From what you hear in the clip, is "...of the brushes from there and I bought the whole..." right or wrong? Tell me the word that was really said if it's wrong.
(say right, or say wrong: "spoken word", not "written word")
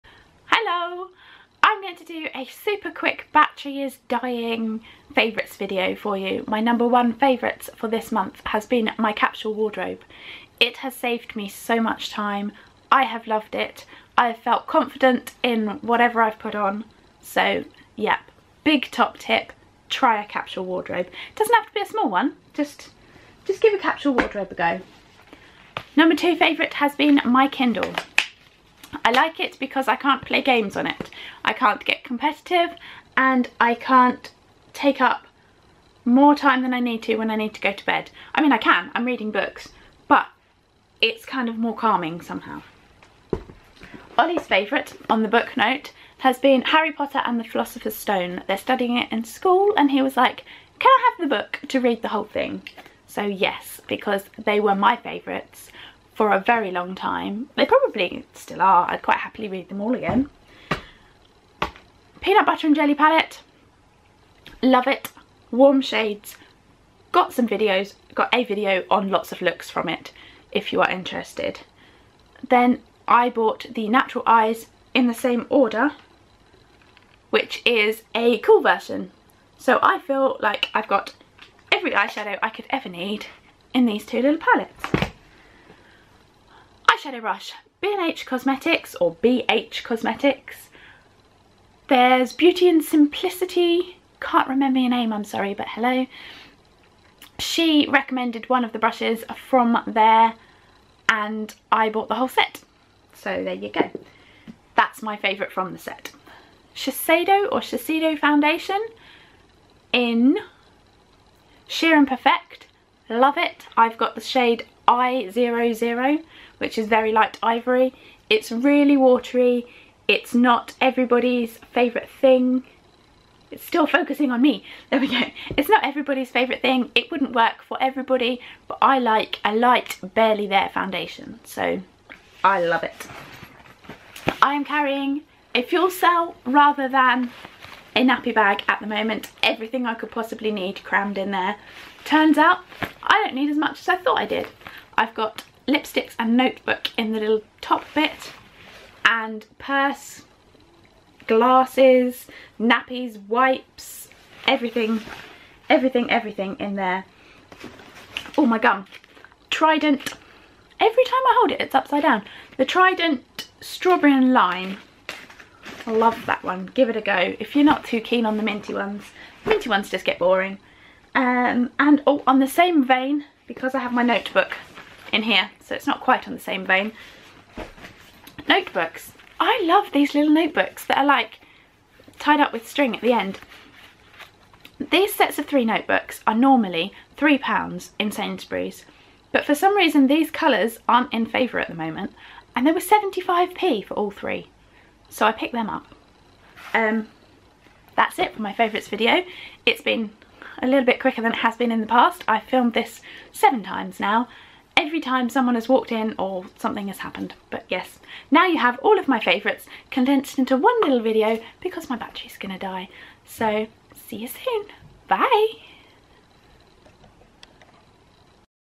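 right.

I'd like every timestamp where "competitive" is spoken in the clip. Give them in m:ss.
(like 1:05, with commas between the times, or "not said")
0:32.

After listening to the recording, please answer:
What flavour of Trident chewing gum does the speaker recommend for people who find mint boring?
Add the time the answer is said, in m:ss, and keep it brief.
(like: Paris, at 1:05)
strawberry and lime, at 2:43.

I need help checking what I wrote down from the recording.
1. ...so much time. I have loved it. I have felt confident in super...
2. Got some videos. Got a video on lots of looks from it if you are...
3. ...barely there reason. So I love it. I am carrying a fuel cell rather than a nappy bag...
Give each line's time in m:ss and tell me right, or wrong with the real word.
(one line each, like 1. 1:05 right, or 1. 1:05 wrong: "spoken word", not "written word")
1. 0:11 wrong: "whatever", not "super"
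2. 1:07 right
3. 2:10 wrong: "foundation", not "reason".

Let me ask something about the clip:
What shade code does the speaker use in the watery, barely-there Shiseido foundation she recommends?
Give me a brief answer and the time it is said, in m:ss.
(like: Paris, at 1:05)
I00, at 1:54.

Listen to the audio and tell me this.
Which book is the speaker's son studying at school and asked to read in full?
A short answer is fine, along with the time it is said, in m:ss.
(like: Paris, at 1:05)
Harry Potter and the Philosopher's Stone, at 0:46.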